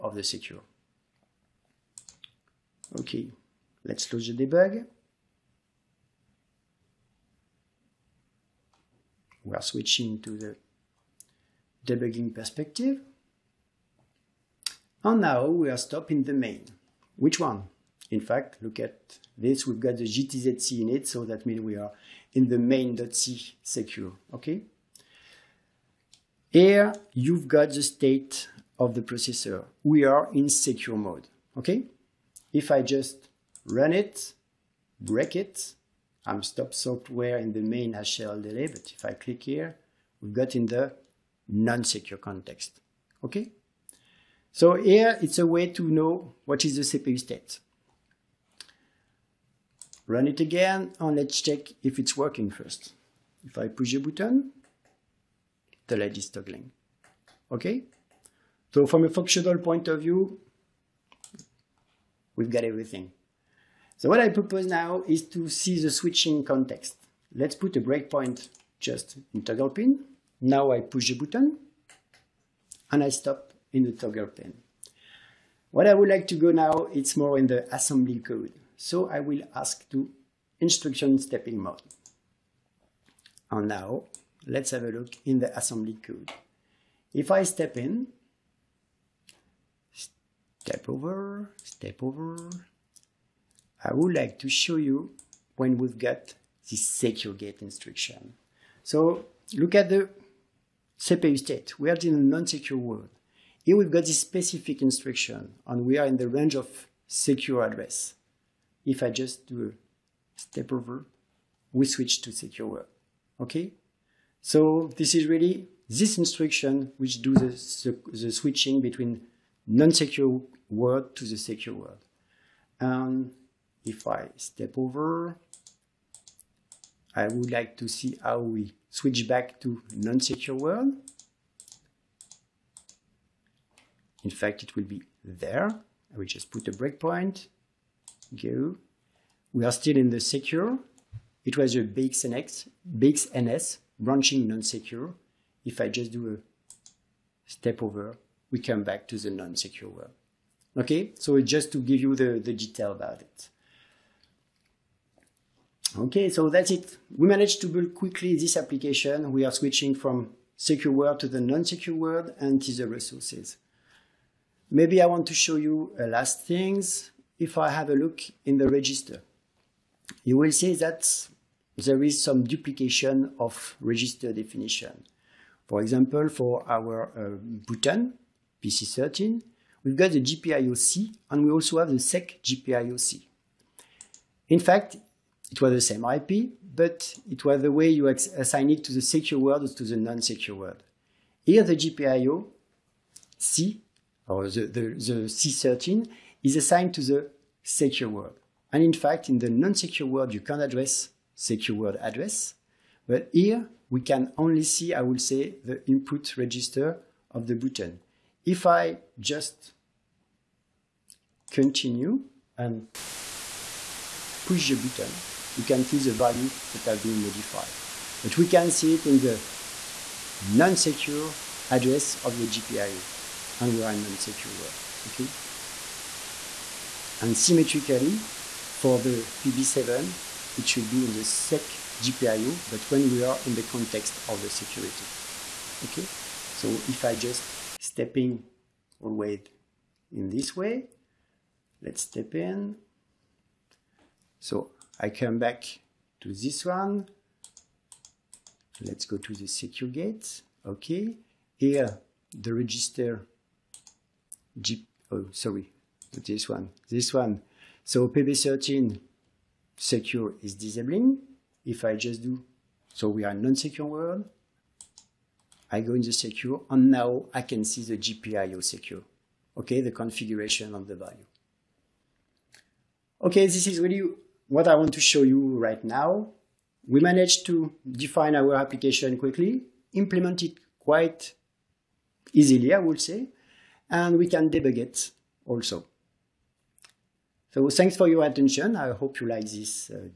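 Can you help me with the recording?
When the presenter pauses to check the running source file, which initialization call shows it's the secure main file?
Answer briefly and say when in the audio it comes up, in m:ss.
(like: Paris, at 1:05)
GTZC init, at 0:20.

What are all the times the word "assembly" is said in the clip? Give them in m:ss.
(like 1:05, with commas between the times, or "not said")
1:17, 1:25.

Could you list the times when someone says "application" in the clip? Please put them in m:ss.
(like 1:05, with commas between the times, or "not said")
2:38, 4:38.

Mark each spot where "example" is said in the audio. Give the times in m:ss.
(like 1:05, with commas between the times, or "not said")
2:55.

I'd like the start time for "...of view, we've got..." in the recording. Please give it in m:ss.
0:59.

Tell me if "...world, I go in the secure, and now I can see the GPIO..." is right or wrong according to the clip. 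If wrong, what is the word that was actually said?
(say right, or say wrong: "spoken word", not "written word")
right.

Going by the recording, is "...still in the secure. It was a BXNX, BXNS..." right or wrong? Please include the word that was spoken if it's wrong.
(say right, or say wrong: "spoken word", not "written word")
right.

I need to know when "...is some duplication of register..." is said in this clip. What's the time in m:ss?
2:52.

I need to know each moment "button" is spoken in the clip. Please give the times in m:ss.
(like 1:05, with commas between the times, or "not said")
0:54, 1:11, 2:57, 3:27, 3:34.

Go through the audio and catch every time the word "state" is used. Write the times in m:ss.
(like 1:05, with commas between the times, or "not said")
0:27, 0:47, 1:41.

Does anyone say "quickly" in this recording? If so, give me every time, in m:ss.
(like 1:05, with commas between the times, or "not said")
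2:37, 4:39.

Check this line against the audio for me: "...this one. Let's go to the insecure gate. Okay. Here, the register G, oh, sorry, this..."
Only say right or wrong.
wrong.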